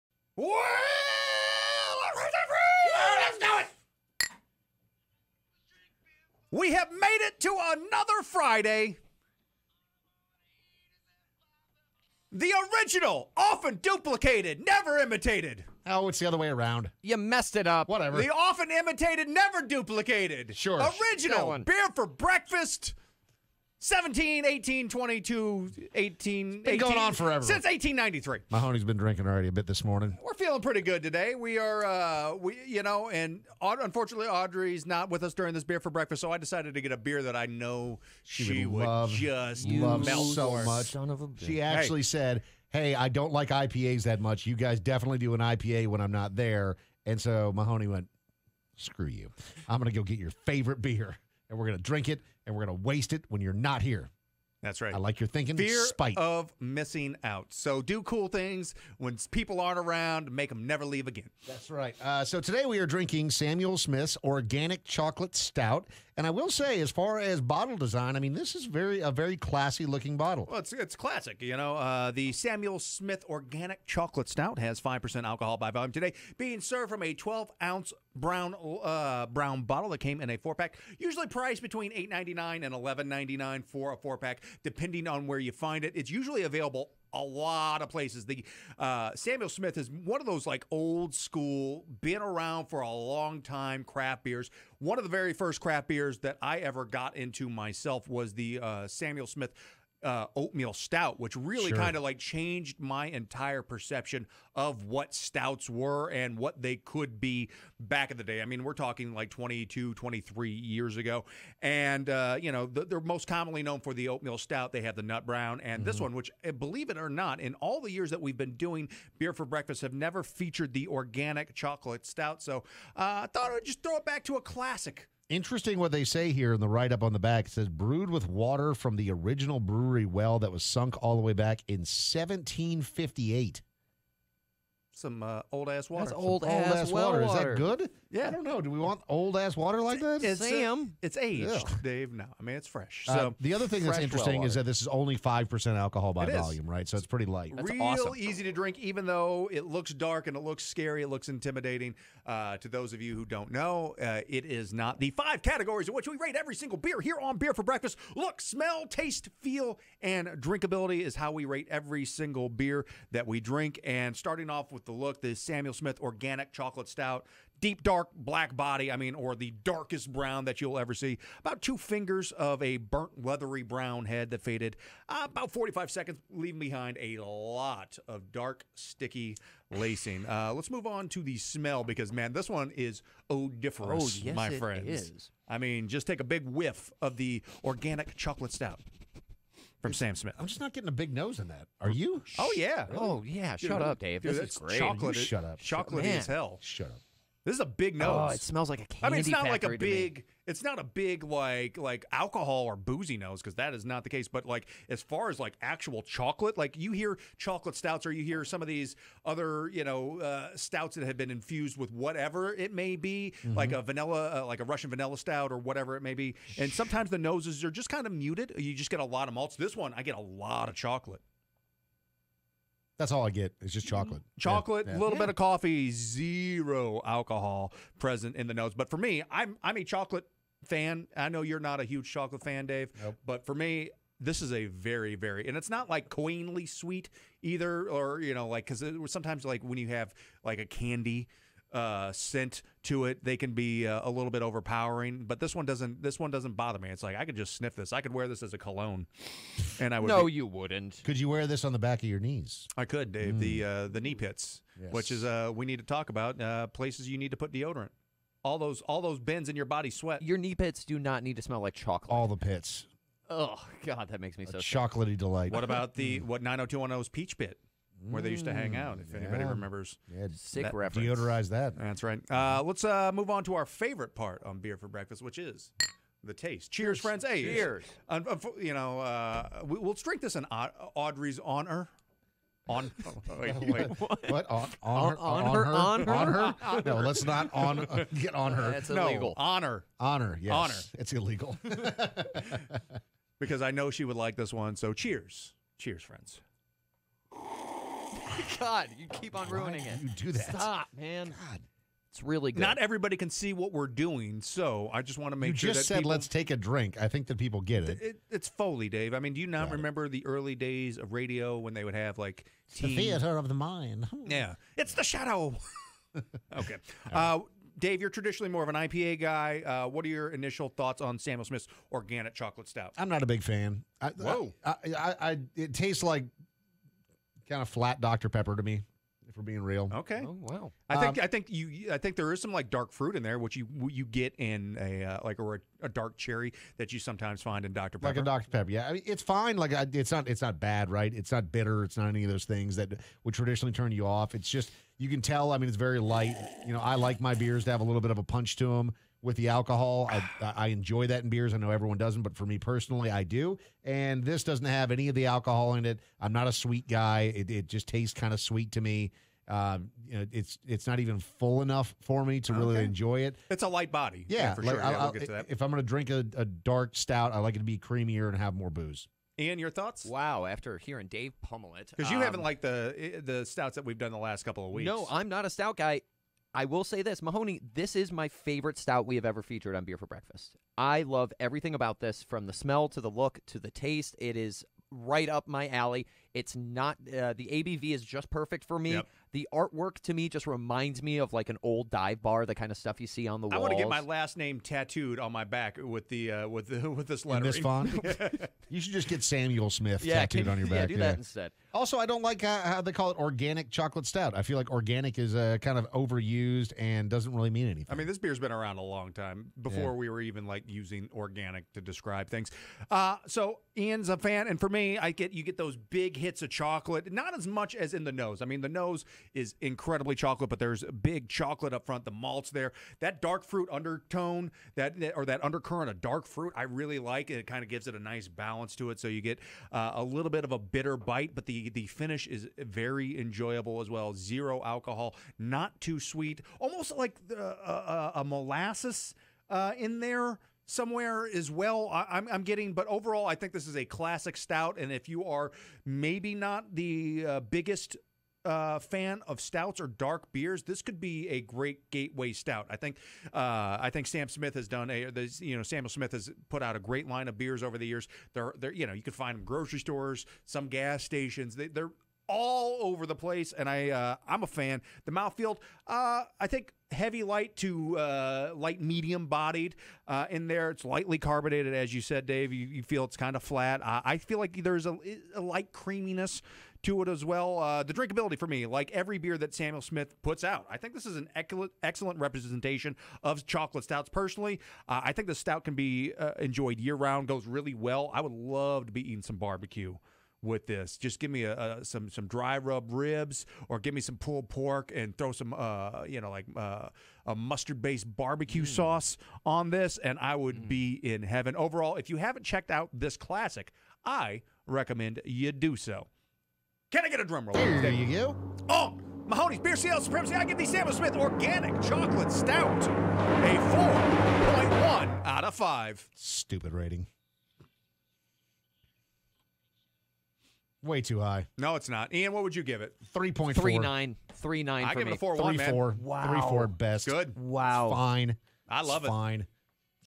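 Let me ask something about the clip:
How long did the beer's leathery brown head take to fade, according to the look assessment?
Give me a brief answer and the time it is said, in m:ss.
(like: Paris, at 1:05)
About 45 seconds, at 2:55.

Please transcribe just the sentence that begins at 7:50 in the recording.
It's lightly carbonated, as you said, Dave.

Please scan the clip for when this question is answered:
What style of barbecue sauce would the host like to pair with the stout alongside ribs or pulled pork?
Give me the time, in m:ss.
8:17.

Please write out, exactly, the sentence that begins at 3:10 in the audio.
I'm just not getting a big nose in that.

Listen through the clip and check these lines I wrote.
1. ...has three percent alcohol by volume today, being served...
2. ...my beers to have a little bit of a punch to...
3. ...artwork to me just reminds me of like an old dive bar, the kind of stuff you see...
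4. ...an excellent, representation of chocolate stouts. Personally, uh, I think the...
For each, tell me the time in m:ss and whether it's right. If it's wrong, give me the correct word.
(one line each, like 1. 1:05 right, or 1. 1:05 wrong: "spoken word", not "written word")
1. 1:14 wrong: "five", not "three"
2. 5:47 right
3. 6:29 right
4. 8:01 right.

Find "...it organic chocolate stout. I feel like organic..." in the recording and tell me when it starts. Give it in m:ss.
6:43.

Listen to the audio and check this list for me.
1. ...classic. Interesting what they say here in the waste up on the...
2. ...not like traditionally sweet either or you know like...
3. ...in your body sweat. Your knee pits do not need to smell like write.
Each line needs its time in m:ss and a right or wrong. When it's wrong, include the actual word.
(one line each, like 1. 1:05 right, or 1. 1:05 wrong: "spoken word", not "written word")
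1. 2:04 wrong: "write", not "waste"
2. 3:55 wrong: "queenly", not "traditionally"
3. 4:19 wrong: "chocolate", not "write".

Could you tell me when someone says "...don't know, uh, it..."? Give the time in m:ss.
2:33.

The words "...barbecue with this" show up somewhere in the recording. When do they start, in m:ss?
8:09.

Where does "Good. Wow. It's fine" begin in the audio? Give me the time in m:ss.
8:47.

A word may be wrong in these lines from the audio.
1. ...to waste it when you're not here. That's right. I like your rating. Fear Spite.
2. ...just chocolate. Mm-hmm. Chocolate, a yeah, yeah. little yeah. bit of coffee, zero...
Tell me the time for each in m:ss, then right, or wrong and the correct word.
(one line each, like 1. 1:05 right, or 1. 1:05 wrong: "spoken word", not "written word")
1. 0:52 wrong: "thinking", not "rating"
2. 3:43 right.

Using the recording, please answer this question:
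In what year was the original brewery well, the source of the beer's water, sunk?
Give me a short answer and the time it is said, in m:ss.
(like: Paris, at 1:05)
1758, at 2:11.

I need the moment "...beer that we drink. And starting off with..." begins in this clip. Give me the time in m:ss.
2:42.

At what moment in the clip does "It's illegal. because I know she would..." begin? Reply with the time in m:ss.
4:50.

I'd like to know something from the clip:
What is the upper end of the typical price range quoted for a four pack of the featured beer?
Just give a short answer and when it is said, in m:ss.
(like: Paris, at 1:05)
$11.99, at 1:22.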